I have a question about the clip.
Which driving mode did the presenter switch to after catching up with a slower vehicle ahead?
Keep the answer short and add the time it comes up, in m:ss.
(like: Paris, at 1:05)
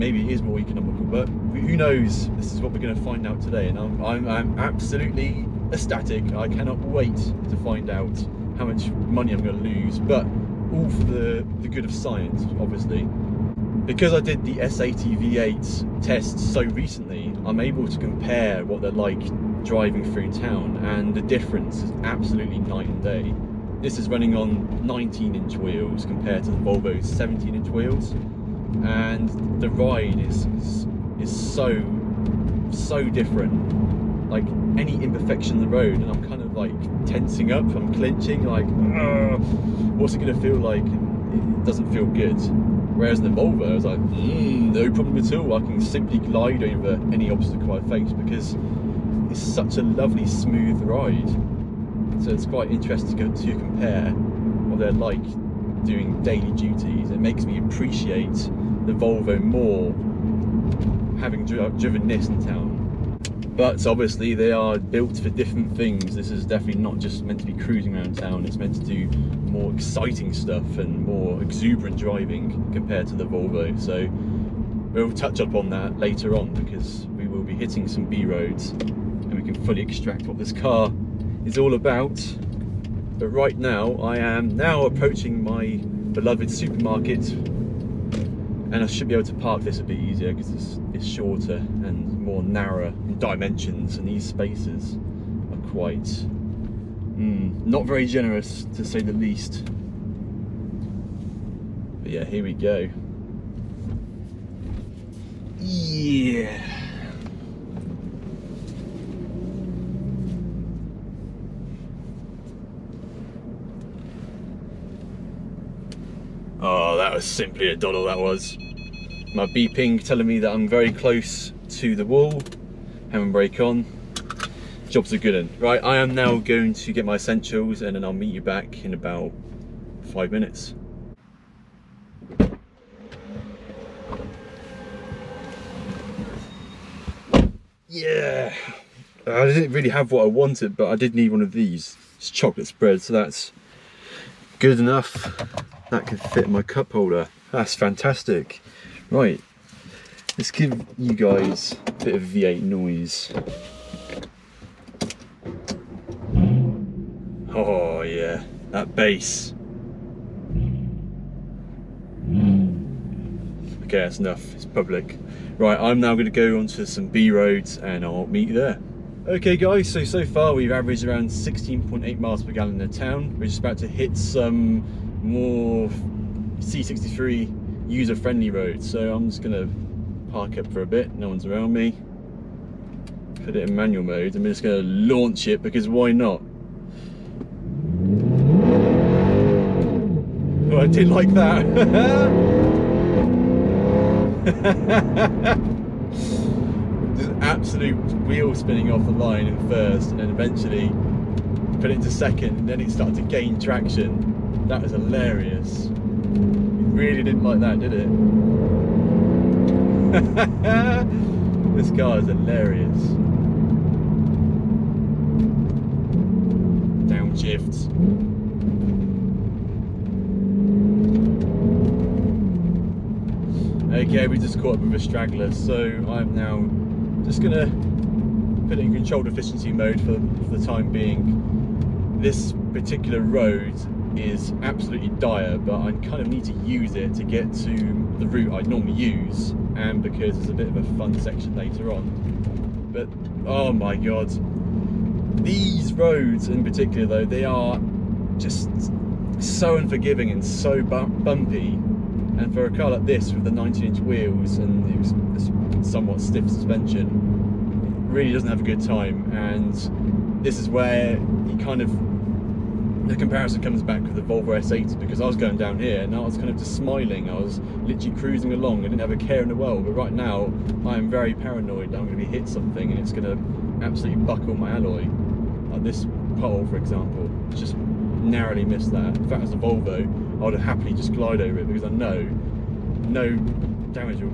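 controlled efficiency mode, at 3:48.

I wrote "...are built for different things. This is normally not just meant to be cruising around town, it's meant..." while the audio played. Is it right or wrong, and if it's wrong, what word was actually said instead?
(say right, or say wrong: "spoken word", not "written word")
wrong: "definitely", not "normally".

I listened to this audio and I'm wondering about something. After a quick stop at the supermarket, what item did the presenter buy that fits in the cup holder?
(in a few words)
chocolate spread.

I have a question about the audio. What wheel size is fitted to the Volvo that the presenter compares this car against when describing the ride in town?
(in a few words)
17 inch.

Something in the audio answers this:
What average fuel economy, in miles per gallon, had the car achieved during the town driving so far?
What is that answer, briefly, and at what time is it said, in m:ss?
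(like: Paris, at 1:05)
16.8, at 2:51.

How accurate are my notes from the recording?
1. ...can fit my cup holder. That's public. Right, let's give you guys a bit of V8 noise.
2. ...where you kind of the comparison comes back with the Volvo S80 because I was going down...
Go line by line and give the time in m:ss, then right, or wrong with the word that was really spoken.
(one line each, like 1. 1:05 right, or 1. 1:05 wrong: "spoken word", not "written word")
1. 2:26 wrong: "fantastic", not "public"
2. 4:20 right.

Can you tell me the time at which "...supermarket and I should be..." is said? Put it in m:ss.
1:26.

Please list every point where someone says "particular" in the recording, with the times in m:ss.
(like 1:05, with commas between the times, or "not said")
3:52, 4:06.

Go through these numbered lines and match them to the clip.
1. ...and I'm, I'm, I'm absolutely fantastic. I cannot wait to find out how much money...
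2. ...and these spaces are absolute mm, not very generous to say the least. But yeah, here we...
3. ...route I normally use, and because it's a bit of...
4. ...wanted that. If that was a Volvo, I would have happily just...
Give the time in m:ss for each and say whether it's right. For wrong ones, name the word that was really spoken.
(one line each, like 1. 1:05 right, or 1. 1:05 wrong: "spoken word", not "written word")
1. 0:03 wrong: "ecstatic", not "fantastic"
2. 1:33 wrong: "quite", not "absolute"
3. 3:58 right
4. 4:38 wrong: "missed", not "wanted".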